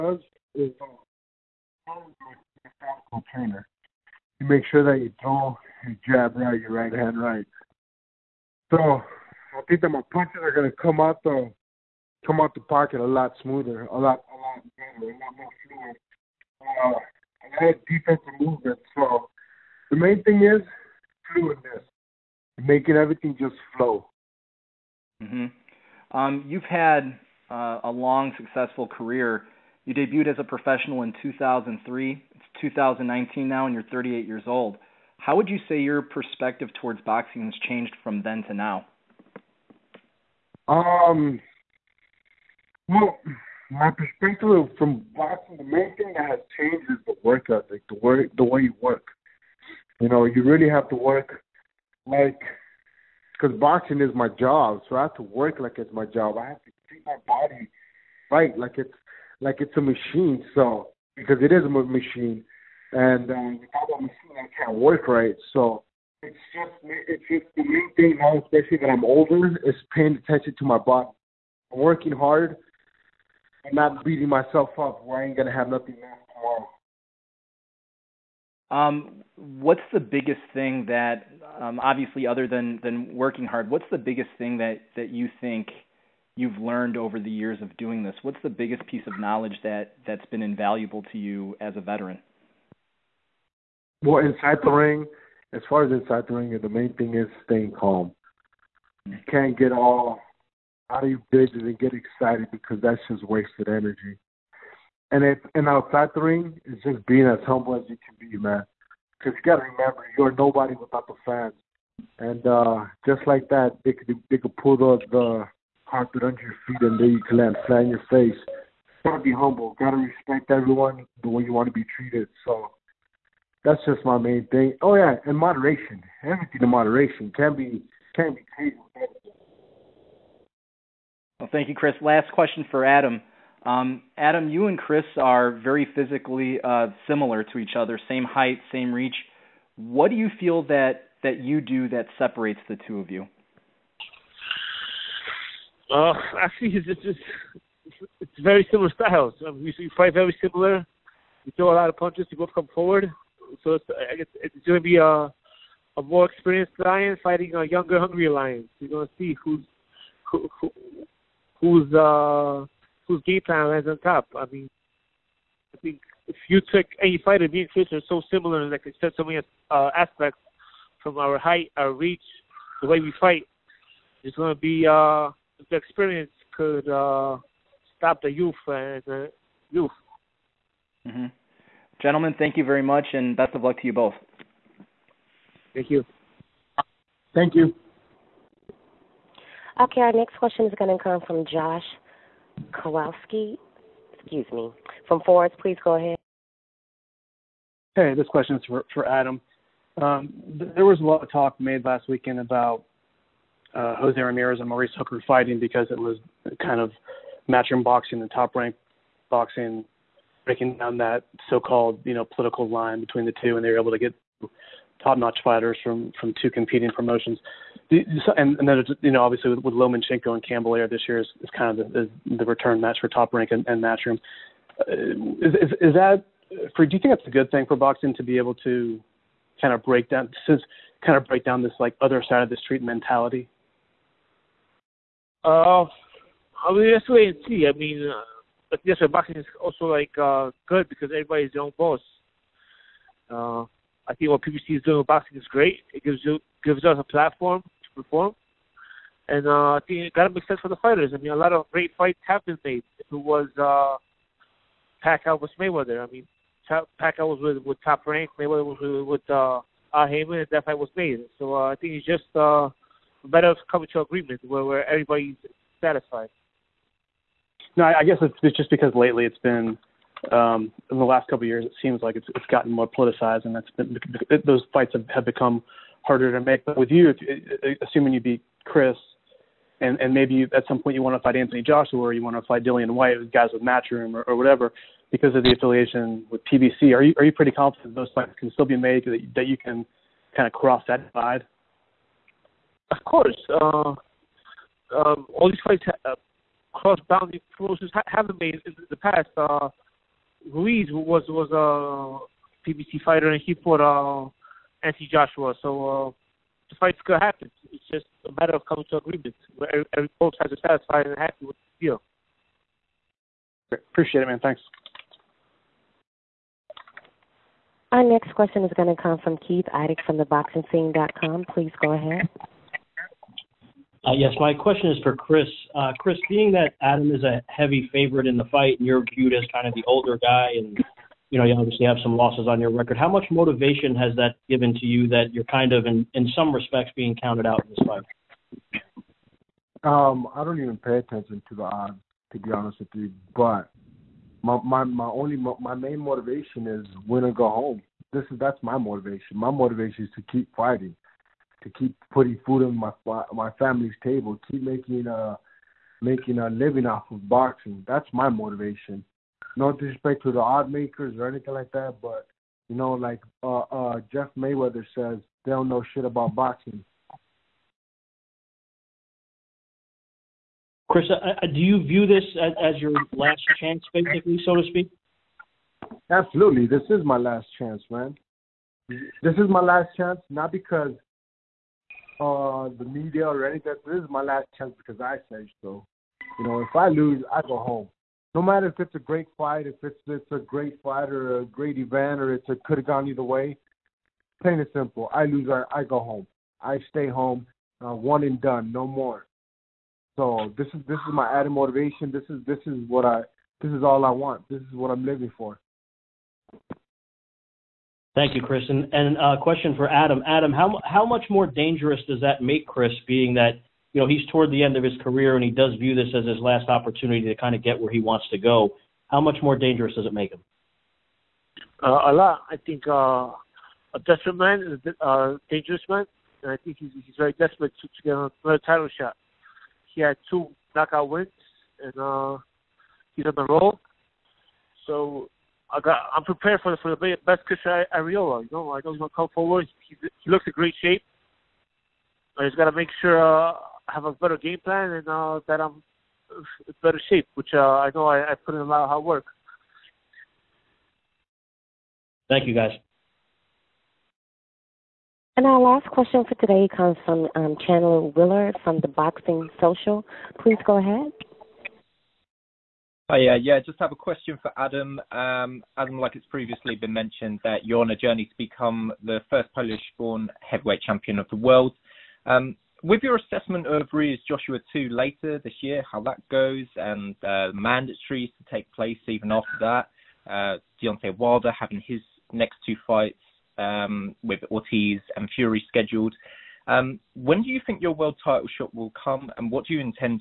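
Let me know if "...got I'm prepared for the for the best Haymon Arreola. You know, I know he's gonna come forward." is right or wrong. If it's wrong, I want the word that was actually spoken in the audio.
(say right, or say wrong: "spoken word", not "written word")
wrong: "Chris", not "Haymon".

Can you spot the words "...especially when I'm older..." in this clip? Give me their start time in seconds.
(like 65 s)
68 s.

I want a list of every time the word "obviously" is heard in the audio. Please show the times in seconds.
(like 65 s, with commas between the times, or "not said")
81 s, 219 s, 331 s.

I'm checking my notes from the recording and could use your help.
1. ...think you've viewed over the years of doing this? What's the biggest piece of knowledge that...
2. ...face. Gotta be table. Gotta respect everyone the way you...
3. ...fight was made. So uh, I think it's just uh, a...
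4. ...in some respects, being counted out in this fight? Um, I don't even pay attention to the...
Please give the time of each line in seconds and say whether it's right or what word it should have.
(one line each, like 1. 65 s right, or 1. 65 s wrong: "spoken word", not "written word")
1. 85 s wrong: "learned", not "viewed"
2. 118 s wrong: "humble", not "table"
3. 260 s right
4. 335 s right.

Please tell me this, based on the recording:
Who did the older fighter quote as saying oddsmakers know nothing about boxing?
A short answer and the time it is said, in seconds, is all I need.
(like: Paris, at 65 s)
Jeff Mayweather, at 364 s.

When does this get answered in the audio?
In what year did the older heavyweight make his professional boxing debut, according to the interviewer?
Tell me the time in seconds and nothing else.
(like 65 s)
31 s.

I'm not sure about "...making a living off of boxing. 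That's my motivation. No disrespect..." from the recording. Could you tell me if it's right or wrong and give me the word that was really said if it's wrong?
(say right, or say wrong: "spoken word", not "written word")
right.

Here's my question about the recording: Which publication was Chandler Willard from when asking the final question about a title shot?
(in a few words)
The Boxing Social.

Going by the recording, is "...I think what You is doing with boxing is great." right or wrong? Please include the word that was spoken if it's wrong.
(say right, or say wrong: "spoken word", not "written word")
wrong: "PBC", not "You".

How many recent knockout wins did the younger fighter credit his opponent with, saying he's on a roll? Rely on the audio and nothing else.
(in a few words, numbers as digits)
2.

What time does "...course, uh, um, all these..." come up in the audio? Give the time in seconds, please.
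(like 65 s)
293 s.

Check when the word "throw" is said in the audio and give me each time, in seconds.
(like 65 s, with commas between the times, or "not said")
5 s, 151 s.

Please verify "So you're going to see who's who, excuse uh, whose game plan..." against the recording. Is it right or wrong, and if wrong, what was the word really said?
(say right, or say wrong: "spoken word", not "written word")
wrong: "whose", not "excuse".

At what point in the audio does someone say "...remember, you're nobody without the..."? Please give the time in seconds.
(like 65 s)
109 s.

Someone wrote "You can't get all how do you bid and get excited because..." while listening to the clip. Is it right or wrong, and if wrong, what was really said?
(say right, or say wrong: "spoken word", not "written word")
right.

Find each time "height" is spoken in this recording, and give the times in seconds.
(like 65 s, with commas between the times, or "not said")
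138 s, 171 s.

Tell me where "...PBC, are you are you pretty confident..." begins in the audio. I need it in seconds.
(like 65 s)
286 s.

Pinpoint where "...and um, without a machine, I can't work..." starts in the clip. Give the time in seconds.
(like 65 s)
62 s.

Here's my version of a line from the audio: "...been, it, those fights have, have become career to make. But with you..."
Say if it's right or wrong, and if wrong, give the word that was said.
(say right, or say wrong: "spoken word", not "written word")
wrong: "harder", not "career".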